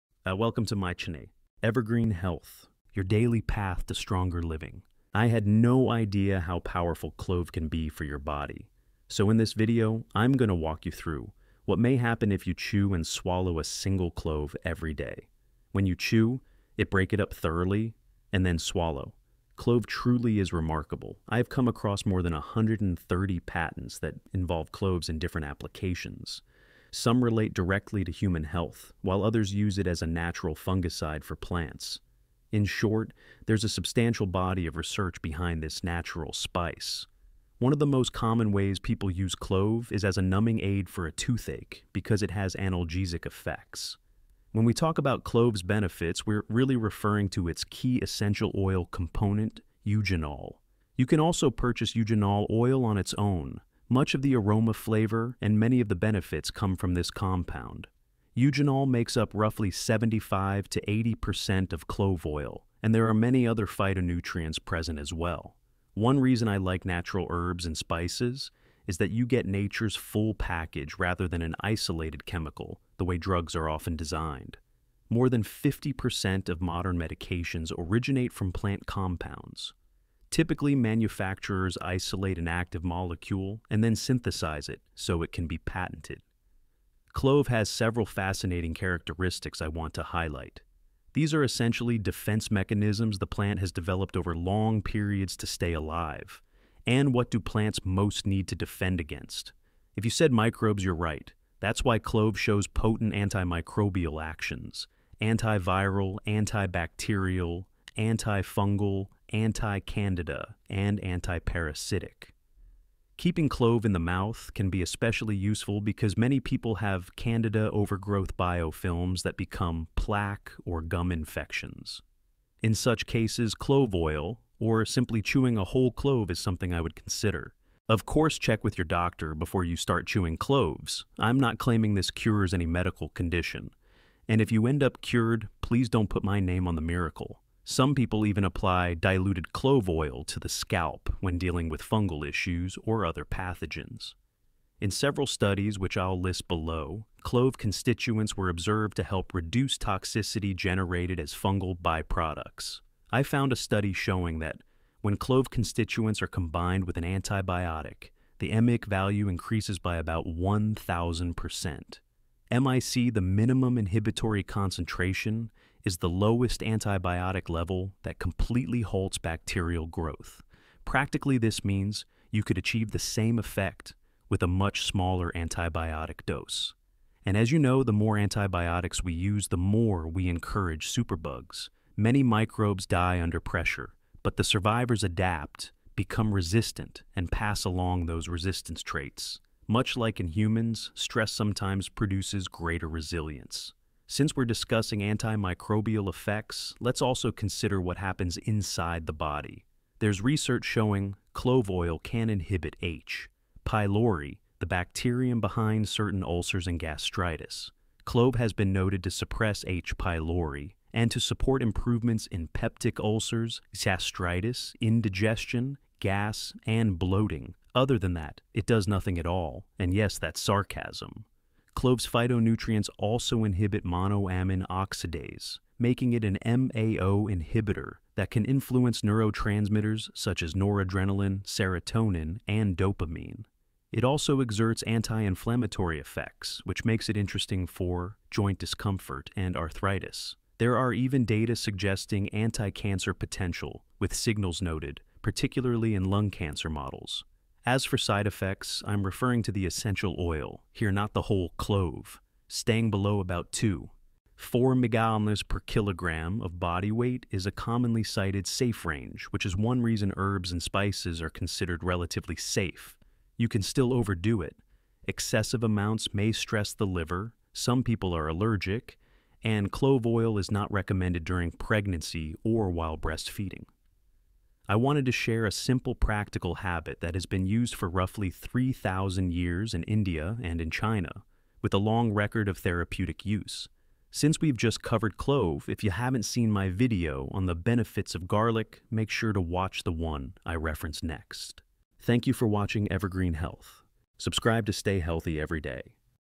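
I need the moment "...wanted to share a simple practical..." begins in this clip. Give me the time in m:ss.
4:34.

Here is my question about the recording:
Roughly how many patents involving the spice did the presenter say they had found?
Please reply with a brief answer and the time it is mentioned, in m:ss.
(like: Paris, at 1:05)
more than 130, at 0:22.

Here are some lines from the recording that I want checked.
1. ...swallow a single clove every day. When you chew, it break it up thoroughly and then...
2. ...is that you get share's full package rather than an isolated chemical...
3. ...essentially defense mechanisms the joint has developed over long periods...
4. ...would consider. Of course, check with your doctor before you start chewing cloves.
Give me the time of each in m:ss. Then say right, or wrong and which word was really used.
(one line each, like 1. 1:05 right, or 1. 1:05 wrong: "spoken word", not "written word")
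1. 0:13 right
2. 1:08 wrong: "nature", not "share"
3. 1:31 wrong: "plant", not "joint"
4. 2:06 right.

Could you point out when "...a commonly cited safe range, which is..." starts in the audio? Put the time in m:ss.
4:17.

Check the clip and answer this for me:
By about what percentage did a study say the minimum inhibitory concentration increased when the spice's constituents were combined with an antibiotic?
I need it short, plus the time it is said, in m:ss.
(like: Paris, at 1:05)
1,000%, at 2:40.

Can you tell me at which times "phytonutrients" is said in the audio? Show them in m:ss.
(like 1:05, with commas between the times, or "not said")
1:03, 3:42.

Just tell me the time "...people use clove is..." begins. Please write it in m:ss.
0:38.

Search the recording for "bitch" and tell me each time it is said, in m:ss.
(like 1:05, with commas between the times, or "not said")
not said.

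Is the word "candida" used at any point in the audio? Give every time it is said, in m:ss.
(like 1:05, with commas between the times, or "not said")
1:49, 1:57.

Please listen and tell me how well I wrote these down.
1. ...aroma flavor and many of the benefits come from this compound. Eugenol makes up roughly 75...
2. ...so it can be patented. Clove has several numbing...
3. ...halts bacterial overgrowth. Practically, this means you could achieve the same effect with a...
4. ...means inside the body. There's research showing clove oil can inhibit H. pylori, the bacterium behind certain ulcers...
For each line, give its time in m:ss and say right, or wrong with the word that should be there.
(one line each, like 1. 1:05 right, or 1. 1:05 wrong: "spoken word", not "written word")
1. 0:54 right
2. 1:24 wrong: "fascinating", not "numbing"
3. 2:48 wrong: "growth", not "overgrowth"
4. 3:17 wrong: "happens", not "means".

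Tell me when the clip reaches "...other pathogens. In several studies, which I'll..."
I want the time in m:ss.
2:23.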